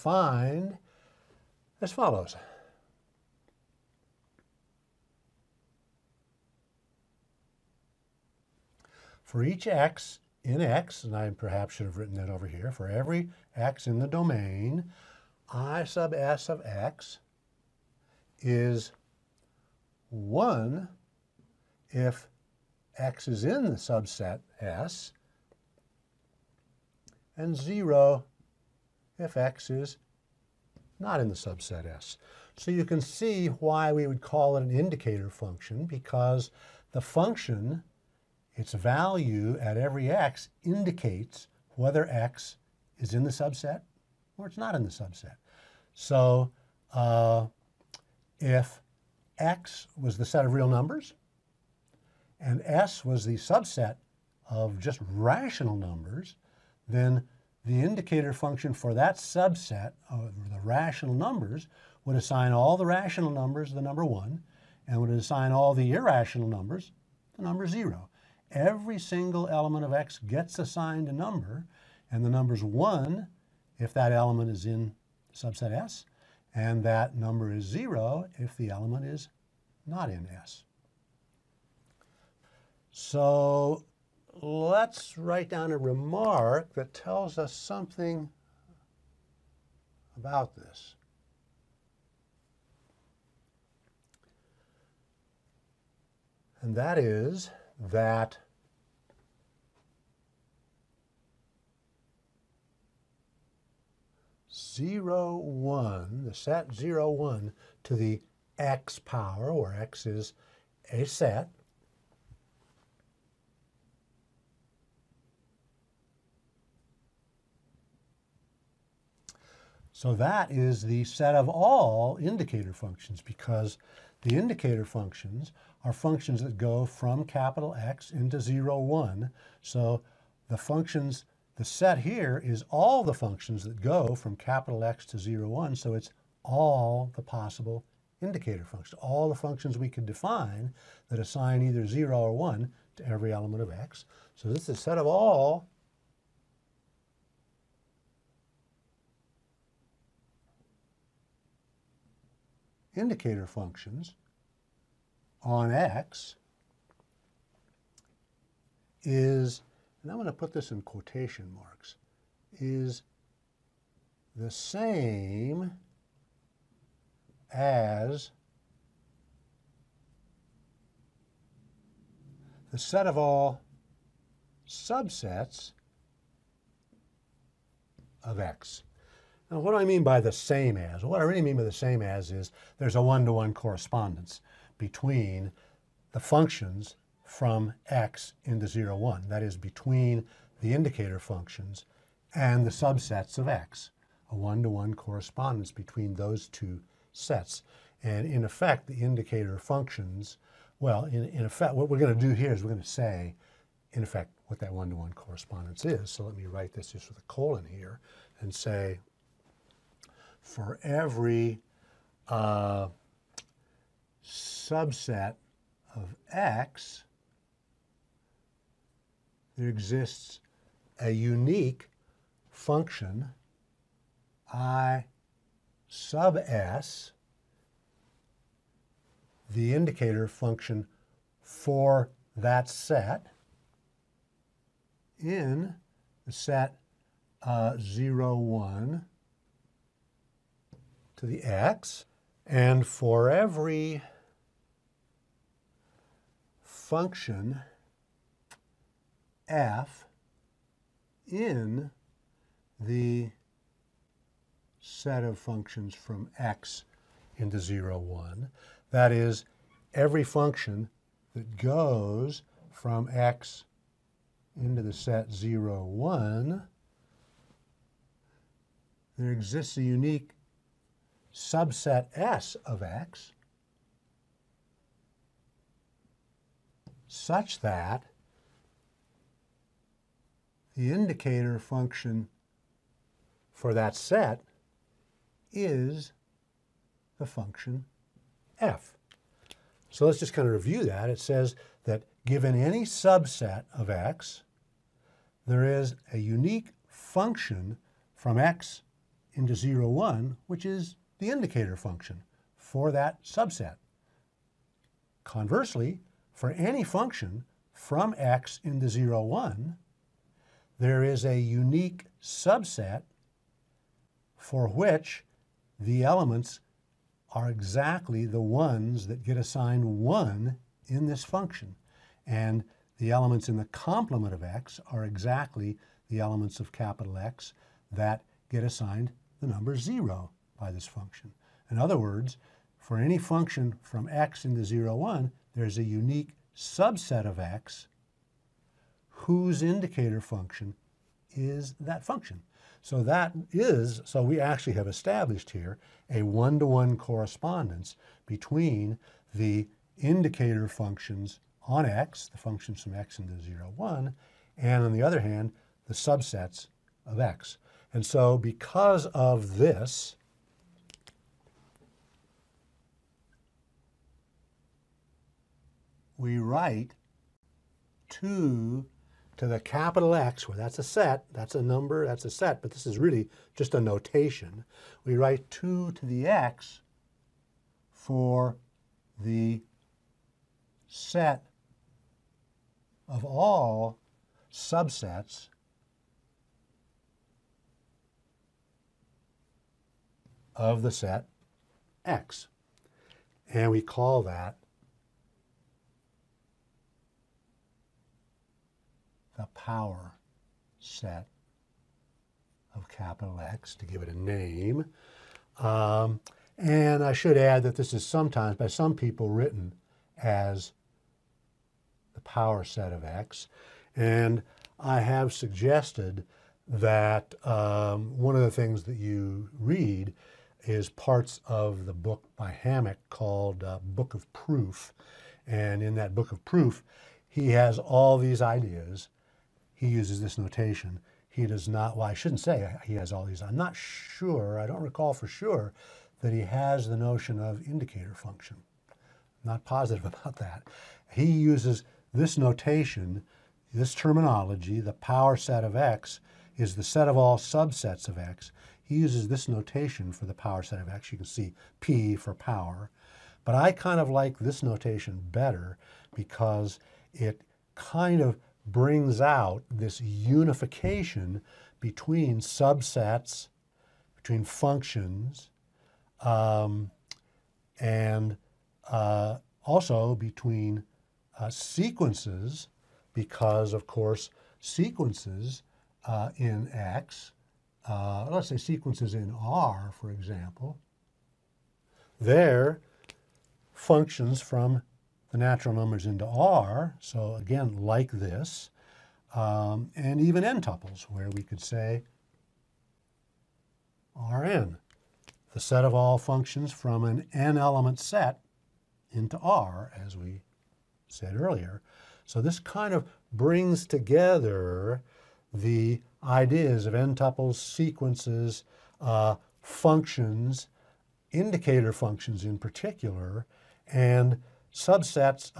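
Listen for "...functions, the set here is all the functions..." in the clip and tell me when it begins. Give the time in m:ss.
2:10.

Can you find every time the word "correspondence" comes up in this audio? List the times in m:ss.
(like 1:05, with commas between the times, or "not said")
3:03, 3:14, 3:25, 5:46.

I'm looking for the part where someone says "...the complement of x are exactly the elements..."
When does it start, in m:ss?
5:23.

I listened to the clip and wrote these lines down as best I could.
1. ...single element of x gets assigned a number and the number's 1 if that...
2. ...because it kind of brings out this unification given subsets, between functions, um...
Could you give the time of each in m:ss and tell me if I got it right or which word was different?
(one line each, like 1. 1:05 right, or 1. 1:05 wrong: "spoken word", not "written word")
1. 1:08 right
2. 7:36 wrong: "between", not "given".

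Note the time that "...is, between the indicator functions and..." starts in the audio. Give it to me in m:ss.
3:09.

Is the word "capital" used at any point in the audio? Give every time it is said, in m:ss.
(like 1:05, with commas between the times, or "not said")
2:07, 2:14, 5:26, 6:09, 6:42.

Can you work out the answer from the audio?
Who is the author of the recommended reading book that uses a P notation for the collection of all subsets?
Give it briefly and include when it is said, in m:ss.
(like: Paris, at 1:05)
Hammack, at 7:02.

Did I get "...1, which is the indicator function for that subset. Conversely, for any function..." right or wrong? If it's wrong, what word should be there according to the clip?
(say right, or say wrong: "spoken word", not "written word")
right.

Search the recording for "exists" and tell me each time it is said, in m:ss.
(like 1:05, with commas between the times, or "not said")
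3:39, 4:29.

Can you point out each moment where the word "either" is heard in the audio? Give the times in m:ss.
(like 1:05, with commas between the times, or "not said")
2:21.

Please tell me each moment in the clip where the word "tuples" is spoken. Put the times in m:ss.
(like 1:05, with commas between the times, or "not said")
8:10, 8:26.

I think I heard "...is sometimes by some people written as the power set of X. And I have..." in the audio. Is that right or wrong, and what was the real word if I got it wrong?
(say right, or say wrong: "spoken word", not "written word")
right.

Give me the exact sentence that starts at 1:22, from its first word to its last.
So let's write down a remark that tells us something about this.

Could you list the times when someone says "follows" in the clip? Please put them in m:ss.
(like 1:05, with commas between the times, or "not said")
0:01.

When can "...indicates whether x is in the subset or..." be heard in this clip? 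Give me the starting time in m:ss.
0:40.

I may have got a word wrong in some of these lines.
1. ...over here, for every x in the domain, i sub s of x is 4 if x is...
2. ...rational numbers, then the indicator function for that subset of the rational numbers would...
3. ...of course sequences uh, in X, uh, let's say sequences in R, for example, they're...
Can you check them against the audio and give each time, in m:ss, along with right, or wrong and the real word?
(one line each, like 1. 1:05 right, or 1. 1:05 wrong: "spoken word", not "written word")
1. 0:12 wrong: "1", not "4"
2. 0:55 right
3. 7:53 right.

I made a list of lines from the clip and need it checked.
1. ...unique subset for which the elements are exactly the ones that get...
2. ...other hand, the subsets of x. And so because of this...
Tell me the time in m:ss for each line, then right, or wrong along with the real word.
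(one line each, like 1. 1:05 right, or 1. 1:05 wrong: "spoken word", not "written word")
1. 5:11 right
2. 5:55 right.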